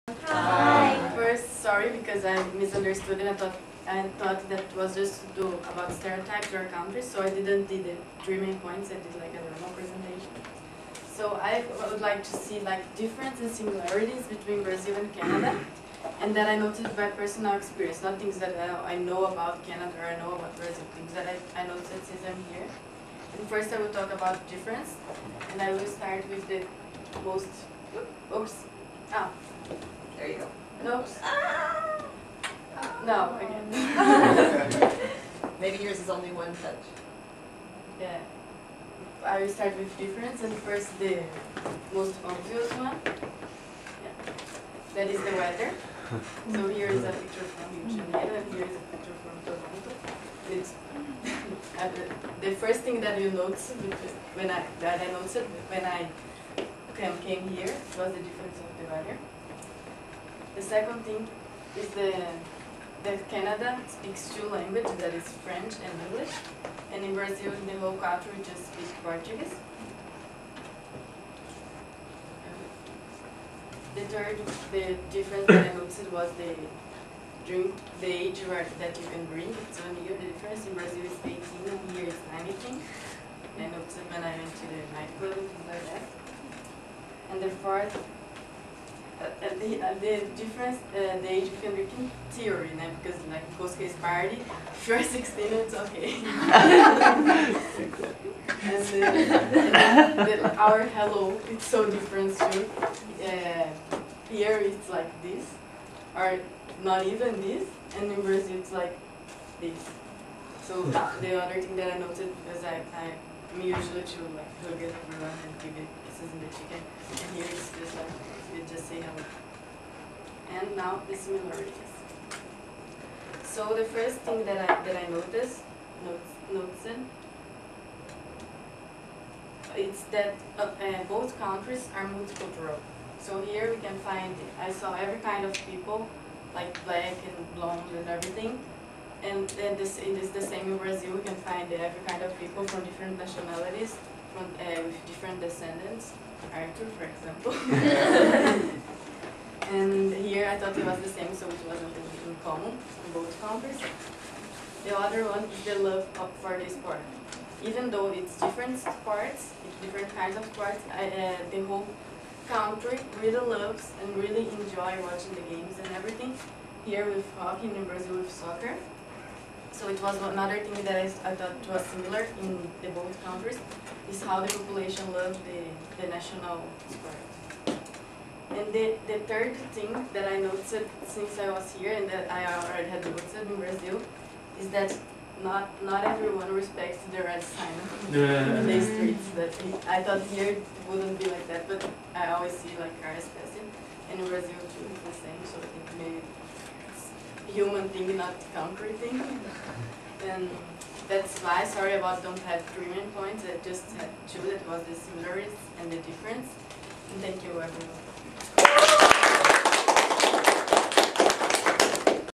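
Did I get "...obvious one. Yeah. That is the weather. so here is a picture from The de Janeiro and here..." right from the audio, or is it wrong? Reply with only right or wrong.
wrong.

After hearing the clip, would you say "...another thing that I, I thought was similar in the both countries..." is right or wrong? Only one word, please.
right.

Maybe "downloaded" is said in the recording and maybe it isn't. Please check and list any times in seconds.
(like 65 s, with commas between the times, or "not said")
not said.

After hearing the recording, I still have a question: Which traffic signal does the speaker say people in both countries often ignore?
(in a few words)
Red sign.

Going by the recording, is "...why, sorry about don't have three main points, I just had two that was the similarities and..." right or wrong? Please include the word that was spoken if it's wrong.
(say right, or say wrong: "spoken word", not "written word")
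right.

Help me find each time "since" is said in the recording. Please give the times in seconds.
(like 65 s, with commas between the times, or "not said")
22 s, 181 s.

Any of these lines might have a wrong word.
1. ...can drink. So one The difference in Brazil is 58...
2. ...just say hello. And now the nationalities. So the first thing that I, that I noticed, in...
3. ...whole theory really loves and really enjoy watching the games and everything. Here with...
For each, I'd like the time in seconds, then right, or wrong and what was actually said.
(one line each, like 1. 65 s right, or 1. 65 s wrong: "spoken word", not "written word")
1. 79 s wrong: "18", not "58"
2. 118 s wrong: "similarities", not "nationalities"
3. 161 s wrong: "country", not "theory".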